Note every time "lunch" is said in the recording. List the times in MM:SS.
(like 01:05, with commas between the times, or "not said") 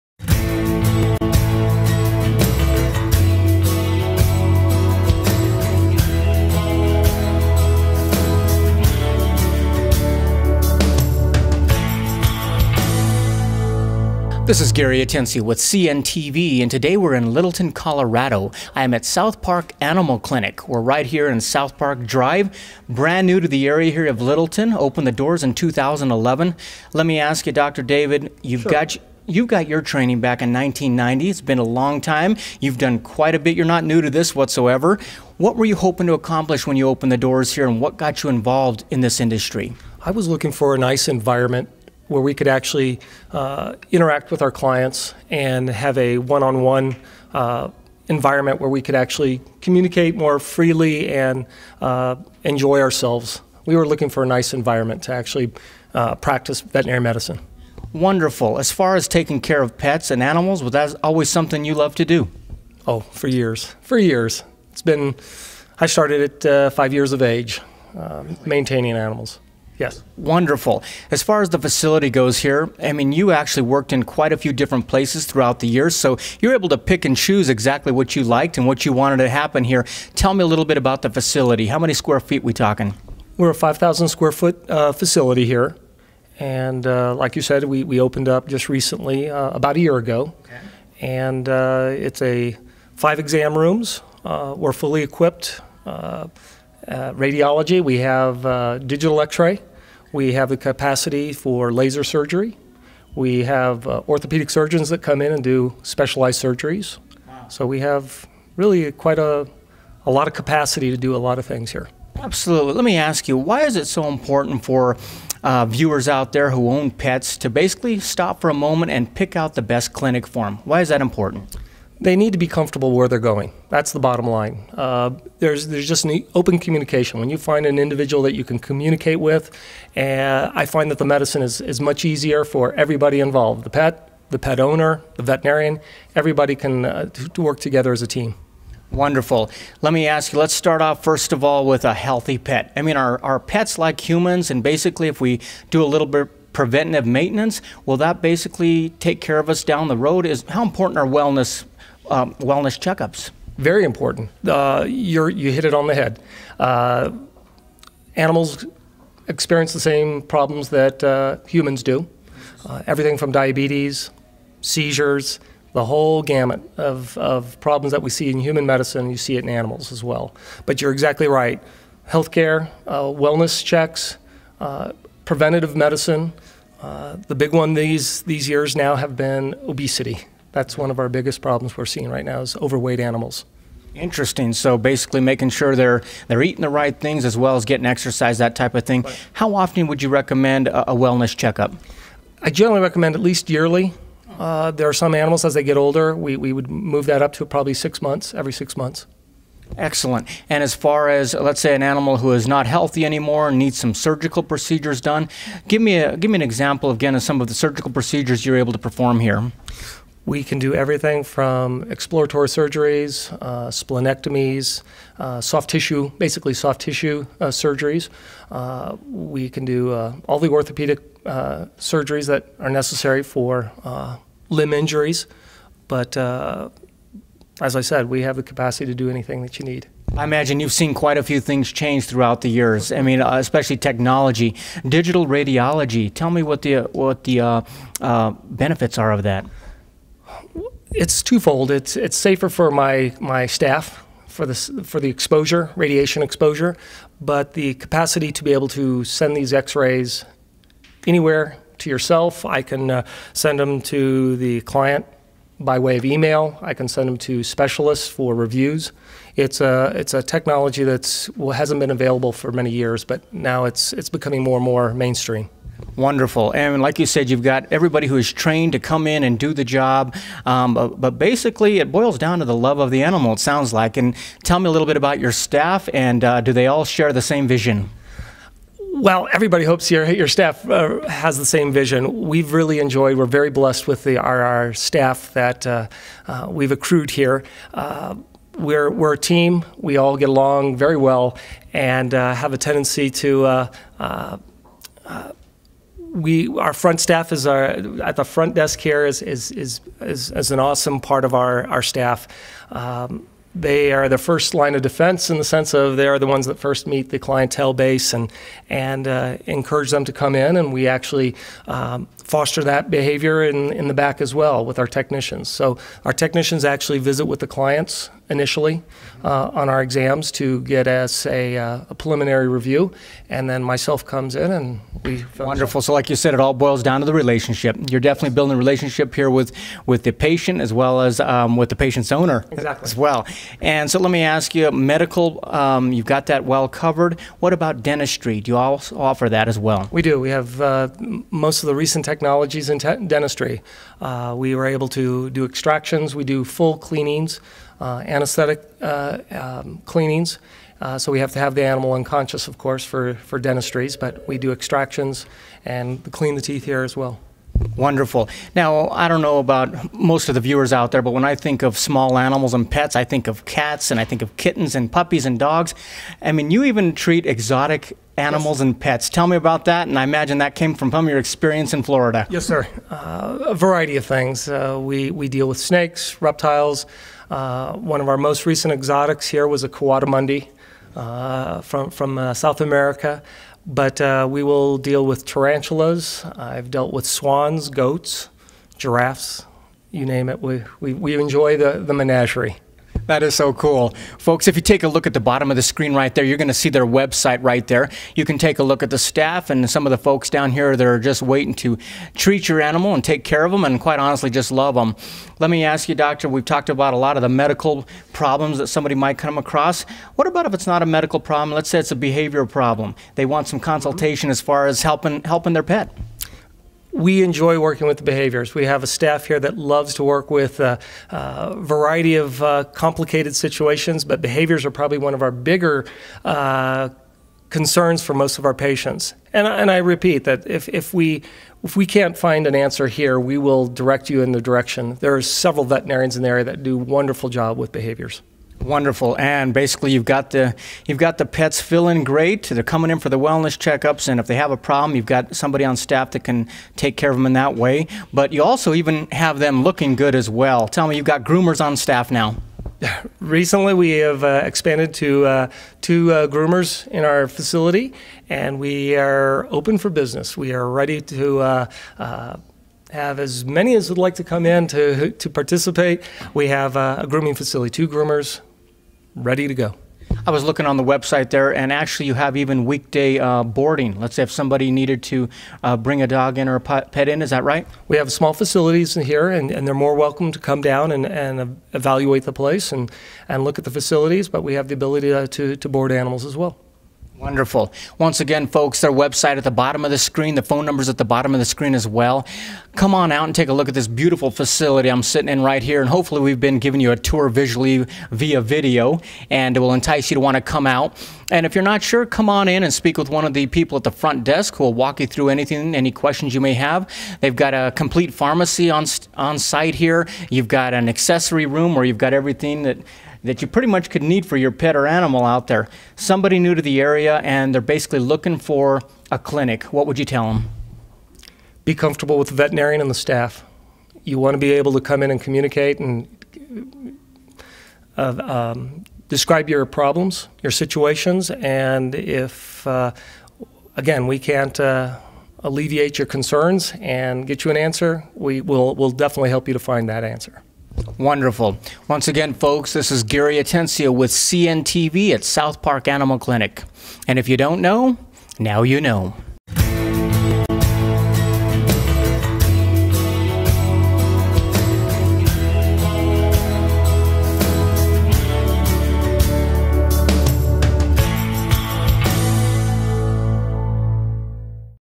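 not said.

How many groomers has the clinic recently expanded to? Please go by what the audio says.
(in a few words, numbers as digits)
2.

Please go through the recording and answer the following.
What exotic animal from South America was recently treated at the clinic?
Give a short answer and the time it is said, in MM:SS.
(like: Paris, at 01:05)
coatimundi, at 06:19.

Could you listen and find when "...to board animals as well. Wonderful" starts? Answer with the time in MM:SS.
08:05.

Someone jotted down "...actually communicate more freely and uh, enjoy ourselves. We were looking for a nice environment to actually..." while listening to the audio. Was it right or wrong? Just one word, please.
right.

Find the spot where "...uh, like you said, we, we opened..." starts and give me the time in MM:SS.
01:26.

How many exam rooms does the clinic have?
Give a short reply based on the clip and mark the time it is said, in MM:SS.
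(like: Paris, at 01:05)
5, at 01:32.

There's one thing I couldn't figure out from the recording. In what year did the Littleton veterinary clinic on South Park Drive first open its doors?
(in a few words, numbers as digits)
2011.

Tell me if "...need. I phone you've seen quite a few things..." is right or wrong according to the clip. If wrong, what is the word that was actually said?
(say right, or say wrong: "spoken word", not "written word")
wrong: "imagine", not "phone".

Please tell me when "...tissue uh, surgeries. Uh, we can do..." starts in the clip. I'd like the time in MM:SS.
03:36.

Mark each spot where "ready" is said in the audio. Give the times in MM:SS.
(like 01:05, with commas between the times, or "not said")
07:40, 07:49.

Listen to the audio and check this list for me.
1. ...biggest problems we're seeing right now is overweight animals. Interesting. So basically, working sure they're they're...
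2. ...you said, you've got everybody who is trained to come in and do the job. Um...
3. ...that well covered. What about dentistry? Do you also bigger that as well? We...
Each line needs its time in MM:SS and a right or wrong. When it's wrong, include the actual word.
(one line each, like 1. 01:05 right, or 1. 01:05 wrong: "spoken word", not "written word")
1. 03:01 wrong: "making", not "working"
2. 04:26 right
3. 05:36 wrong: "offer", not "bigger".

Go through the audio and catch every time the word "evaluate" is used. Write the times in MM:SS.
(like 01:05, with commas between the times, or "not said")
08:01.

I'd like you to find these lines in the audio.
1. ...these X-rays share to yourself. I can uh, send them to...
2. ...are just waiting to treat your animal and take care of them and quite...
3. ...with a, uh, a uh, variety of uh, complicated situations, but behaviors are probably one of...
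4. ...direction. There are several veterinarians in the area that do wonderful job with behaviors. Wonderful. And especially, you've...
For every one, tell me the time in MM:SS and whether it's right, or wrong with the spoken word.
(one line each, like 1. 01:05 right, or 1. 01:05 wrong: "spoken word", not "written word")
1. 04:09 wrong: "anywhere", not "share"
2. 06:40 right
3. 07:00 right
4. 07:14 wrong: "basically", not "especially".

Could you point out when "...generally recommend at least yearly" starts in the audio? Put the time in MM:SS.
03:12.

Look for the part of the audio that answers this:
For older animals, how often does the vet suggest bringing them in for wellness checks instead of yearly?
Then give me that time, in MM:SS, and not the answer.
03:18.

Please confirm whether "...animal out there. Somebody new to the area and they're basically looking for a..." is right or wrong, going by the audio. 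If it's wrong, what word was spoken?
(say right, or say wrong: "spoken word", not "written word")
right.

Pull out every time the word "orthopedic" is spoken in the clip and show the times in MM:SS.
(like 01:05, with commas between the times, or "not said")
01:44, 03:40.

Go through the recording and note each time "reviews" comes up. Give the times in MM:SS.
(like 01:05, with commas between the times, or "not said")
04:18, 05:22.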